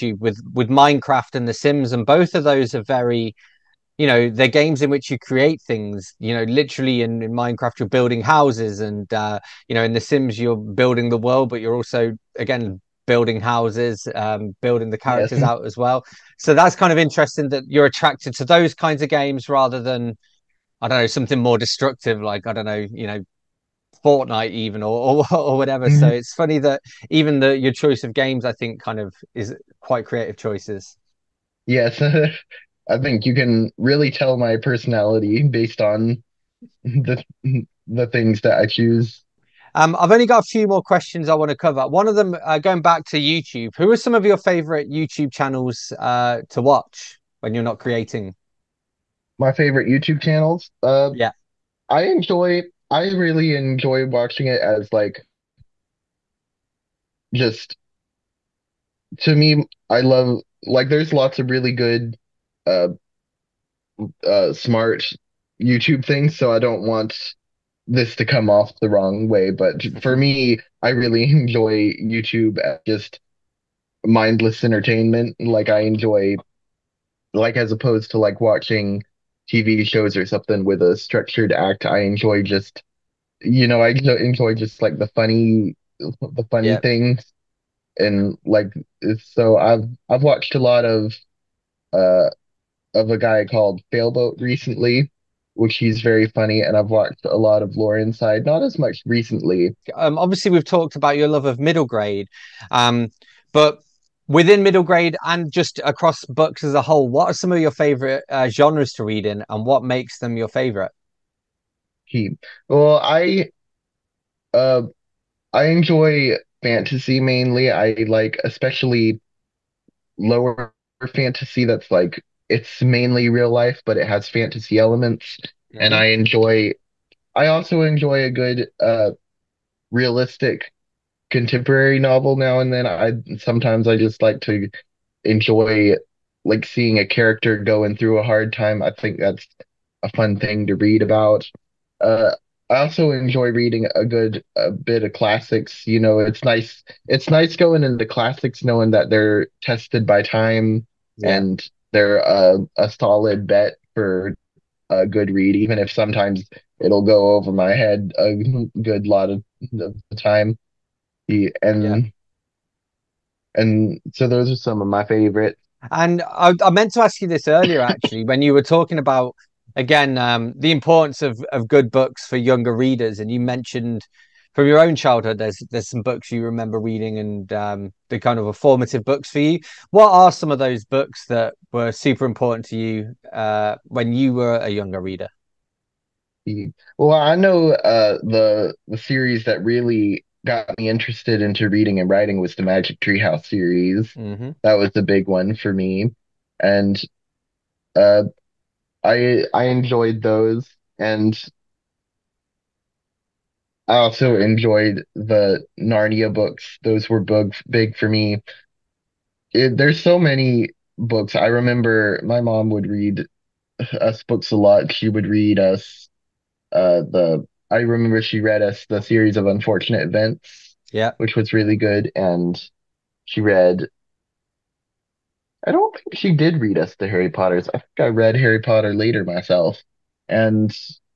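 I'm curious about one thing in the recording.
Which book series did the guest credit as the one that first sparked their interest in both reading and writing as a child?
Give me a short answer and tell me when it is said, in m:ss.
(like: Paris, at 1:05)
Magic Treehouse, at 3:12.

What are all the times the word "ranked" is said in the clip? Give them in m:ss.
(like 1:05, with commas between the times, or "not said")
not said.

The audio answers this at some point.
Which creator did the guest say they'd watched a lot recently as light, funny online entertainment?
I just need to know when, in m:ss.
1:33.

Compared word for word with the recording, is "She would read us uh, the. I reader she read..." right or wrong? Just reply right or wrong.
wrong.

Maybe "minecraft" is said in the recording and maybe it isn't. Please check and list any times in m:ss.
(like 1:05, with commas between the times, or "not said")
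0:00, 0:07.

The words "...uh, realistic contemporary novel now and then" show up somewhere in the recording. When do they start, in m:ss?
2:08.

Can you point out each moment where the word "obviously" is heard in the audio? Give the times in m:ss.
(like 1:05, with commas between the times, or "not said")
1:40.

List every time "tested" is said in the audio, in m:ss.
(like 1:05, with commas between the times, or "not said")
2:29.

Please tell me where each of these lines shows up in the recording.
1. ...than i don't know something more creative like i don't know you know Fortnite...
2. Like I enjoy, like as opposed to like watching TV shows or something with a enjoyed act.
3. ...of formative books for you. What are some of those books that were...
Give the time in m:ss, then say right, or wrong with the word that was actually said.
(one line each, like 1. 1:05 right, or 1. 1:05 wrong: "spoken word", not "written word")
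1. 0:19 wrong: "destructive", not "creative"
2. 1:15 wrong: "structured", not "enjoyed"
3. 2:58 right.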